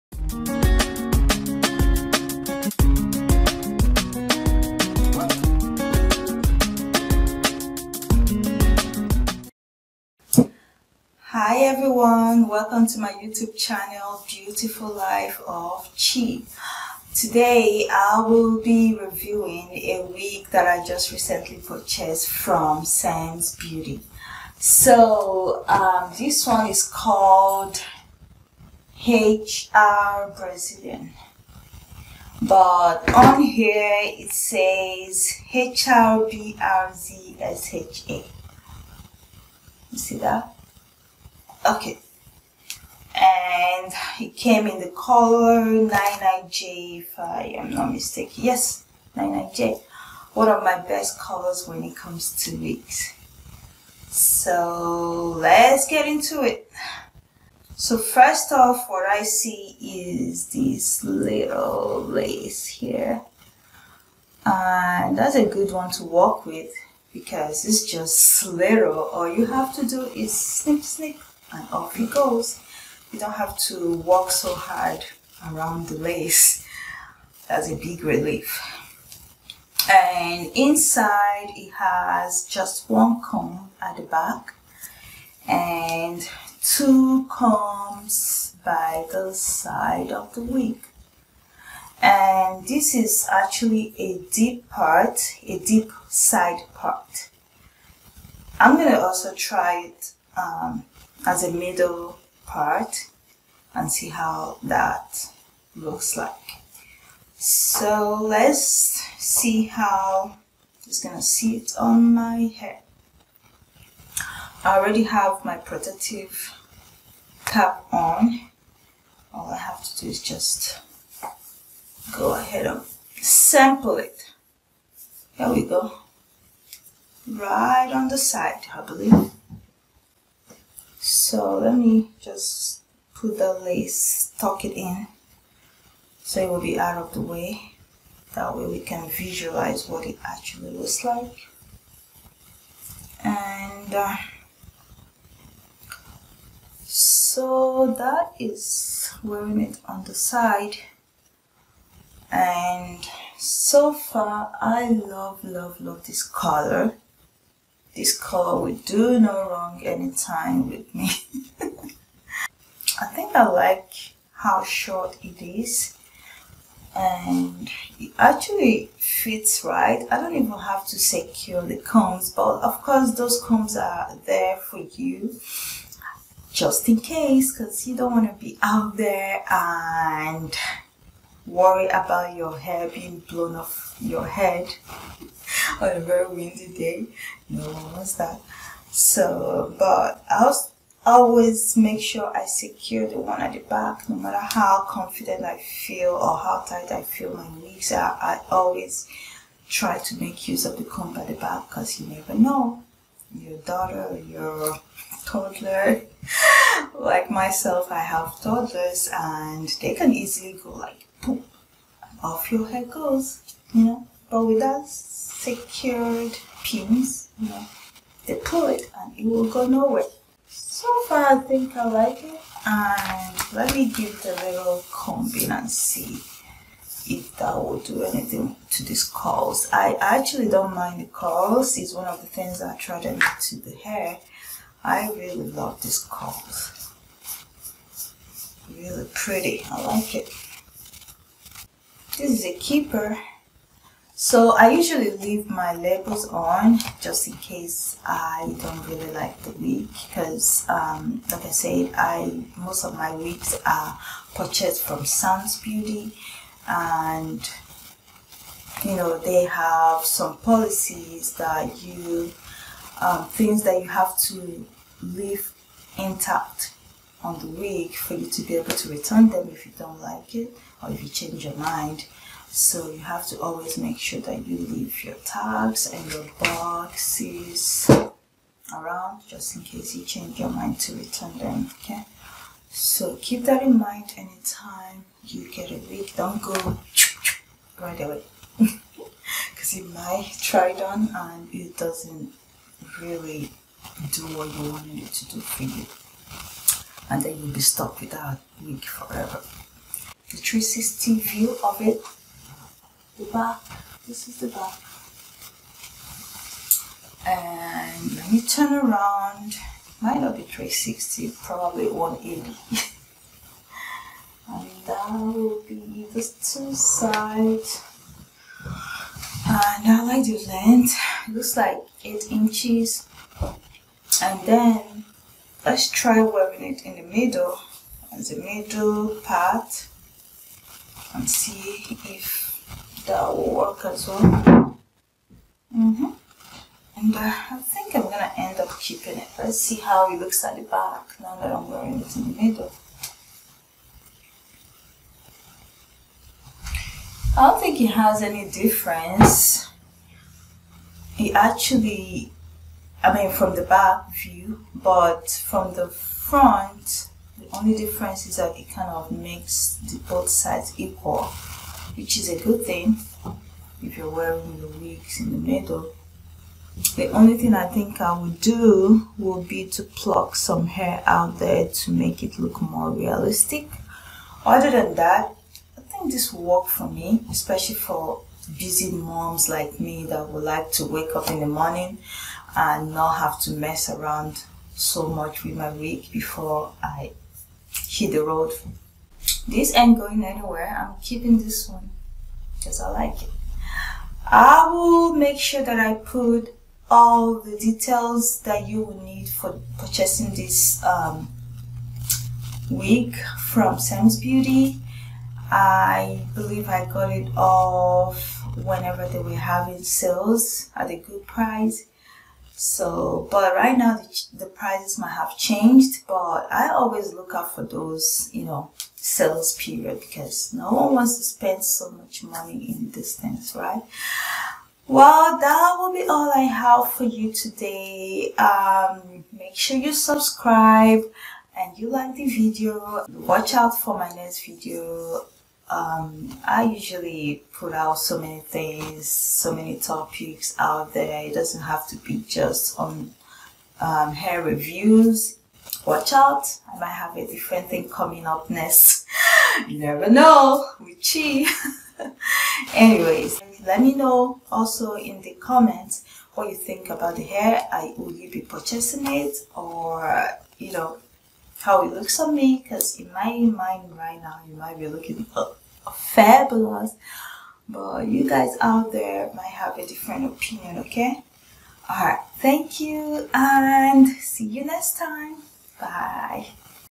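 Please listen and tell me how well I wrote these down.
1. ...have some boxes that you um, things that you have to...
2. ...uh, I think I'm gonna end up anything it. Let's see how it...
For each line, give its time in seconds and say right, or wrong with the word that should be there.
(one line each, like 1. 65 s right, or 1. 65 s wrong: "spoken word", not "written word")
1. 259 s wrong: "policies", not "boxes"
2. 337 s wrong: "keeping", not "anything".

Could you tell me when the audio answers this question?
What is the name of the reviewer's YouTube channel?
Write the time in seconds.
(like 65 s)
14 s.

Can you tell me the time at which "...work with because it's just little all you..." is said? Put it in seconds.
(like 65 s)
66 s.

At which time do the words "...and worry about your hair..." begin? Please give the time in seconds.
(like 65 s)
179 s.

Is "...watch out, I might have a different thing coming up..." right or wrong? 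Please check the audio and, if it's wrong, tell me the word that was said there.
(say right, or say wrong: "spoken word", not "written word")
right.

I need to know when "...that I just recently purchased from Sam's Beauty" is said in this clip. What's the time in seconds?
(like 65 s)
20 s.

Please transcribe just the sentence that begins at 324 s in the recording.
And then let's try wearing it in the middle as the middle part and see if the work as well.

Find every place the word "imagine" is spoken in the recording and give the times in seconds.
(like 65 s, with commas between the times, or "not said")
not said.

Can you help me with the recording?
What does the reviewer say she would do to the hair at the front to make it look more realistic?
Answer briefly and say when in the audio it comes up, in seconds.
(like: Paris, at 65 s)
pluck some hair, at 369 s.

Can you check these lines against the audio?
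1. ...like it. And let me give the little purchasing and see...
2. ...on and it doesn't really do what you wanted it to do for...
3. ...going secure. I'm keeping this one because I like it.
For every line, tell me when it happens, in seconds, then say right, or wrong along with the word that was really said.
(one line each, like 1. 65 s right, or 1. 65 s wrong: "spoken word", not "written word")
1. 221 s wrong: "combing", not "purchasing"
2. 290 s right
3. 389 s wrong: "anywhere", not "secure".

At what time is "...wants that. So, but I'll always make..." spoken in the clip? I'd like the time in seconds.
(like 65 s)
187 s.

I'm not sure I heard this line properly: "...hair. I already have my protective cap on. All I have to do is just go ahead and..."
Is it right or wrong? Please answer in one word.
right.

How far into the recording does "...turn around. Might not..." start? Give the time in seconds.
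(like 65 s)
308 s.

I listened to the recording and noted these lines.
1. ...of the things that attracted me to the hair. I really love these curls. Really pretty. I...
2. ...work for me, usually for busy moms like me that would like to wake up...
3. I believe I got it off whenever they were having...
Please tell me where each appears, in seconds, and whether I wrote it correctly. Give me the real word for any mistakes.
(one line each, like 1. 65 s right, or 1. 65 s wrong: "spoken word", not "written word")
1. 232 s right
2. 376 s wrong: "especially", not "usually"
3. 405 s right.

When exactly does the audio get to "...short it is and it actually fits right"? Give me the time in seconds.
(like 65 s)
164 s.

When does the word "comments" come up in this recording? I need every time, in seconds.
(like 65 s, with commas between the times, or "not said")
455 s.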